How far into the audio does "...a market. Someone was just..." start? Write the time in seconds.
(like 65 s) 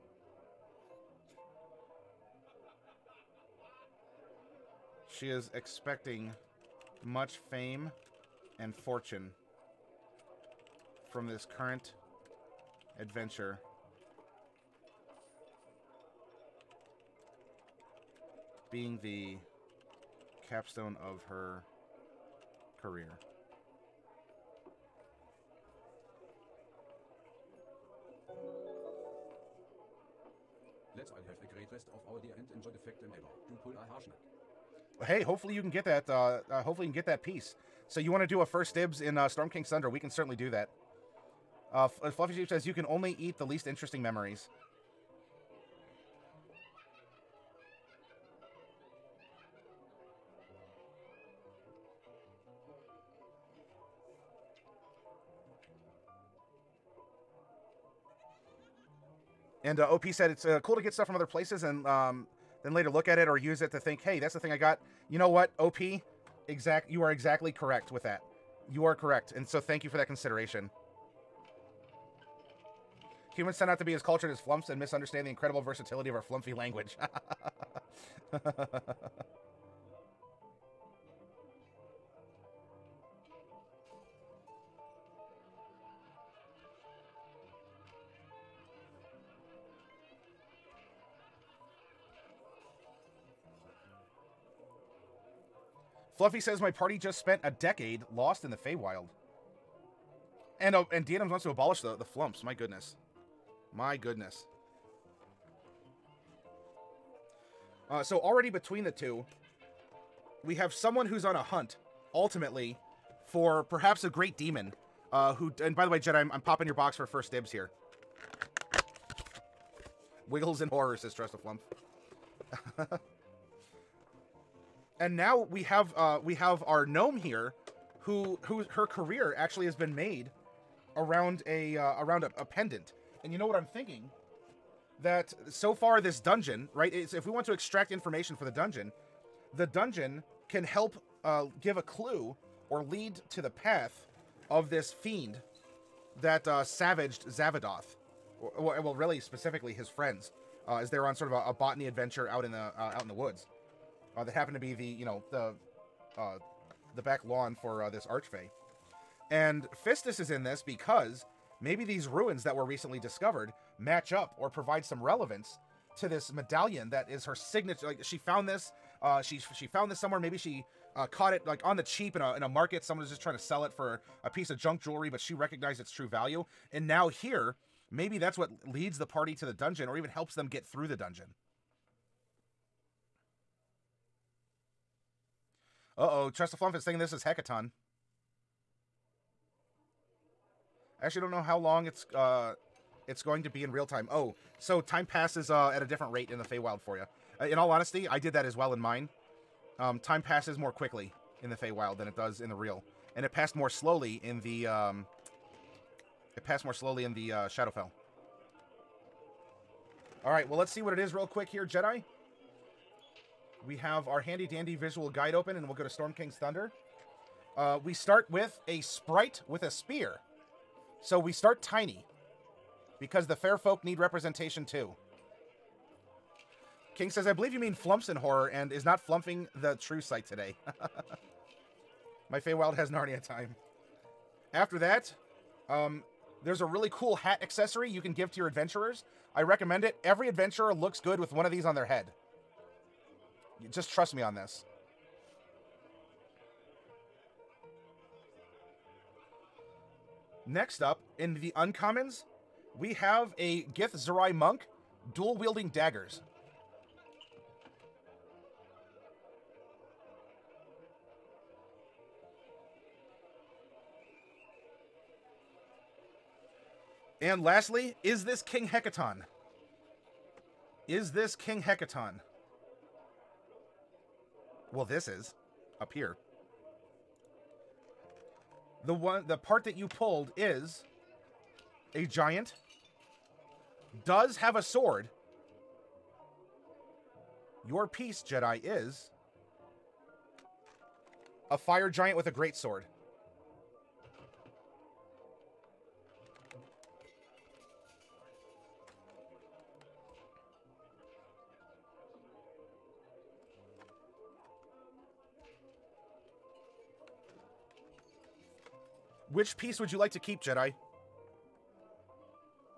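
172 s.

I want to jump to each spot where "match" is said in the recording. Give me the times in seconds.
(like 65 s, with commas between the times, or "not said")
163 s.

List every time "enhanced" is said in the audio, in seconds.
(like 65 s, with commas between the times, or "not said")
not said.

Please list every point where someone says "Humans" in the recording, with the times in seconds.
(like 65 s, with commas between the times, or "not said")
73 s.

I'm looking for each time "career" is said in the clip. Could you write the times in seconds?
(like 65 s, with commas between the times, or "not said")
22 s, 128 s.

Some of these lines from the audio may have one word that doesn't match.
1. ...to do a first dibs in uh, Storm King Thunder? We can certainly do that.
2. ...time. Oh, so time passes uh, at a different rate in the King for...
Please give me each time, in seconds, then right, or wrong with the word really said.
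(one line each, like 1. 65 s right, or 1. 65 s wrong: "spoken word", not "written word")
1. 38 s right
2. 193 s wrong: "Feywild", not "King".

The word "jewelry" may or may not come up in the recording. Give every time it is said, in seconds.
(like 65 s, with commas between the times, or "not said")
174 s.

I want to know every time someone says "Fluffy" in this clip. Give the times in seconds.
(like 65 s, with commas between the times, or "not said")
42 s, 96 s.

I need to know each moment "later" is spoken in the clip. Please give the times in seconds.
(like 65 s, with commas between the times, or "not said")
62 s.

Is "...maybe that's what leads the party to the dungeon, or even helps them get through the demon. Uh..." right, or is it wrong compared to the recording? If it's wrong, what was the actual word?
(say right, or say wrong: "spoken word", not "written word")
wrong: "dungeon", not "demon".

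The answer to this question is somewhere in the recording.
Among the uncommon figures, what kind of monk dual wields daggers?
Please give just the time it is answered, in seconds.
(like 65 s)
253 s.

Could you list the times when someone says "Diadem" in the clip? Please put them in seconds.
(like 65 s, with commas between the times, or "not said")
101 s.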